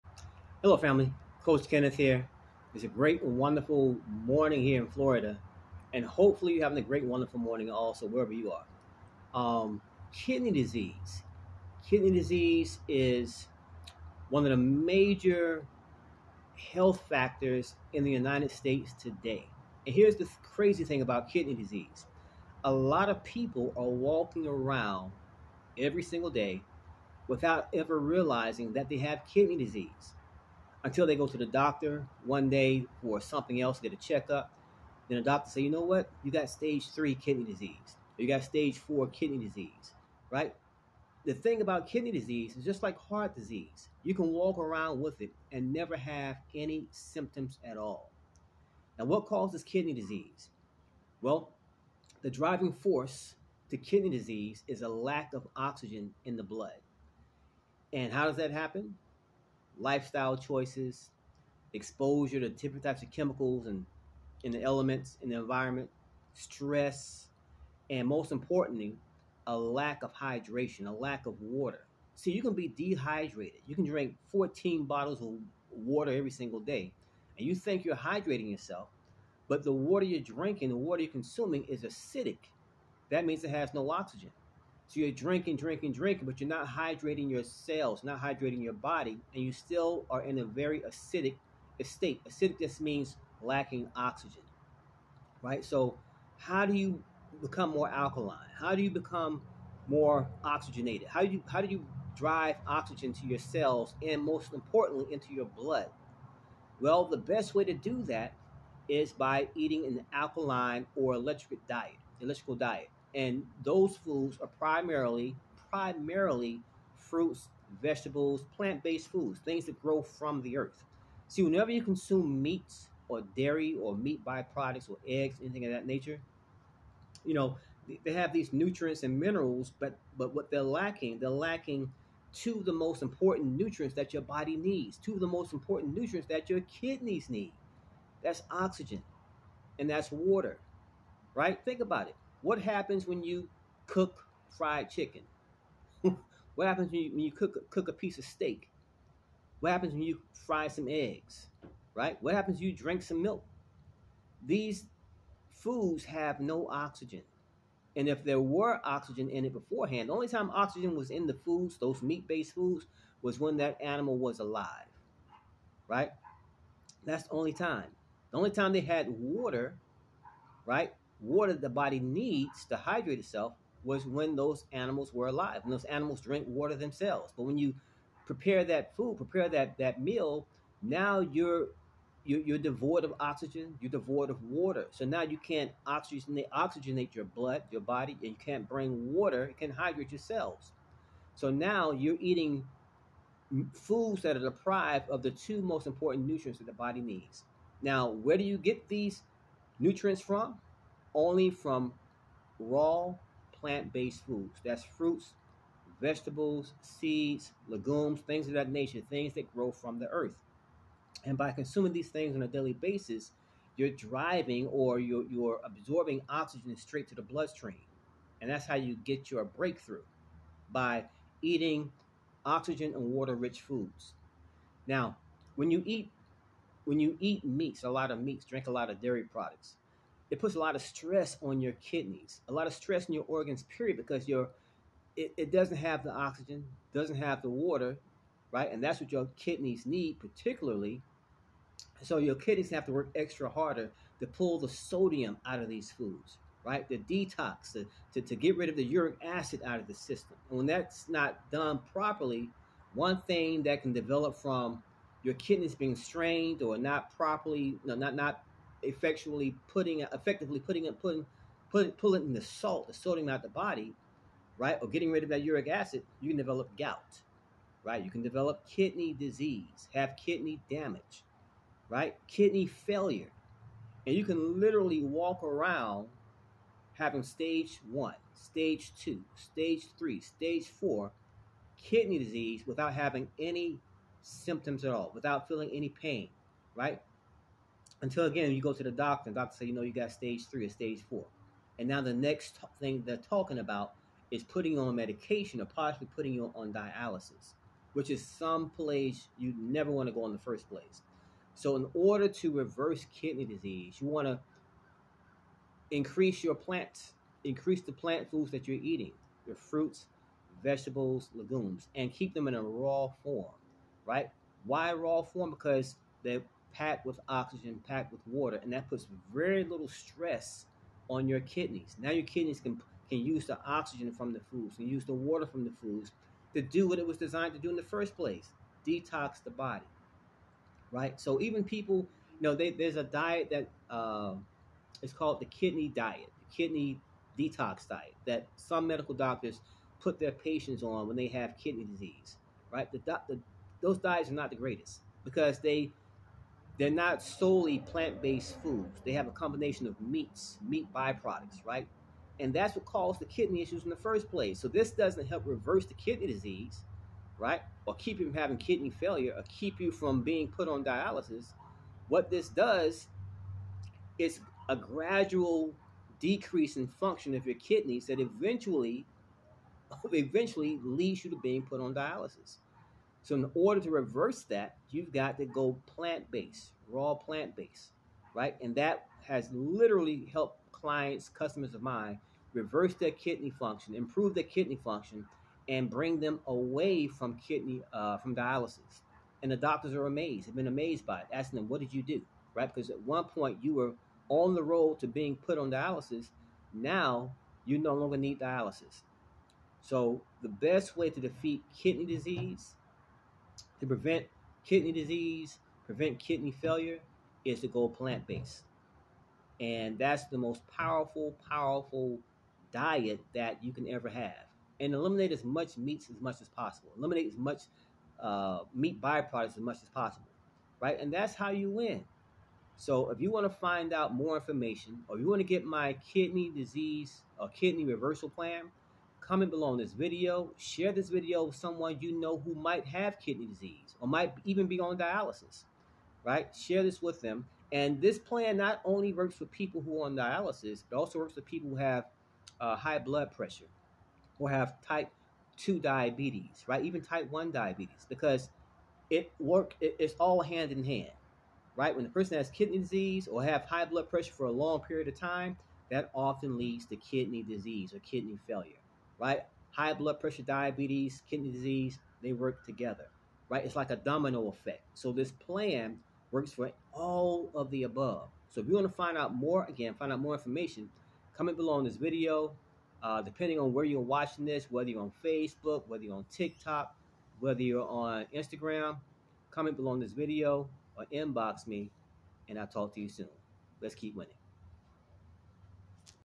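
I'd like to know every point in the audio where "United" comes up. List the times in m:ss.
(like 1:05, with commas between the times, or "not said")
0:18.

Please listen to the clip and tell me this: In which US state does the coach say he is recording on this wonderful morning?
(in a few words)
Florida.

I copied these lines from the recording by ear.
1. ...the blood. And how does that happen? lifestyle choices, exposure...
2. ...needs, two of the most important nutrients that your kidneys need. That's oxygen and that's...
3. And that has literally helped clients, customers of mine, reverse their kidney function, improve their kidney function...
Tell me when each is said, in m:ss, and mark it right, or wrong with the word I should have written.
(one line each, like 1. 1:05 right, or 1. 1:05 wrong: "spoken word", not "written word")
1. 0:56 right
2. 2:14 right
3. 6:18 right.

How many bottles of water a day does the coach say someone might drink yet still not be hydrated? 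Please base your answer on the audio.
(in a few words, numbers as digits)
14.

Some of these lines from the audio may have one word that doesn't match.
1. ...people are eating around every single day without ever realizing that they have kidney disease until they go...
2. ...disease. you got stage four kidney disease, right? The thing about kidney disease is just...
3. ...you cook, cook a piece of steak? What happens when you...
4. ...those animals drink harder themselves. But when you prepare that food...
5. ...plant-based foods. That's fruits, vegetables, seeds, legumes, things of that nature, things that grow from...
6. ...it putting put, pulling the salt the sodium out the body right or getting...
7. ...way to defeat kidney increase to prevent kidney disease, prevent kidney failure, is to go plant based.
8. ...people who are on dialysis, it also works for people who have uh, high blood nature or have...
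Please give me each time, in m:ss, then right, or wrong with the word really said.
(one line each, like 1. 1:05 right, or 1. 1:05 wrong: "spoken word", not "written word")
1. 0:23 wrong: "walking", not "eating"
2. 0:37 right
3. 2:27 right
4. 2:55 wrong: "water", not "harder"
5. 3:23 right
6. 4:20 right
7. 6:40 wrong: "disease", not "increase"
8. 7:19 wrong: "pressure", not "nature".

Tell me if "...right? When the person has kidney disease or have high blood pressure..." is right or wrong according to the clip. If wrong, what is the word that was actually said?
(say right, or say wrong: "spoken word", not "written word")
right.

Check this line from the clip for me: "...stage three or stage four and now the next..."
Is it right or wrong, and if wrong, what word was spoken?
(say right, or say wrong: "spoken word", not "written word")
right.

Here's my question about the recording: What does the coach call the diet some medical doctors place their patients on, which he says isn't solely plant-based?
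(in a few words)
Kidney detox diet.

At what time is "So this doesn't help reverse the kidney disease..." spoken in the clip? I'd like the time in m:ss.
5:54.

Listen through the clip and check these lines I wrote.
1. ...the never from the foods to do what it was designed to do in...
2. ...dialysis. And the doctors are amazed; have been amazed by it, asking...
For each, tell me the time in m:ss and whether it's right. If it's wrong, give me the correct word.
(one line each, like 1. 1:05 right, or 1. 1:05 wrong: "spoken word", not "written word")
1. 5:25 wrong: "water", not "never"
2. 6:28 right.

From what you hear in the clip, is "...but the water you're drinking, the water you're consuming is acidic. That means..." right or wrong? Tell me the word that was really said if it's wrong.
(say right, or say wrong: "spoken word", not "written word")
right.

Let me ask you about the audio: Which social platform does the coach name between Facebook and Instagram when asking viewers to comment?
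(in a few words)
TikTok.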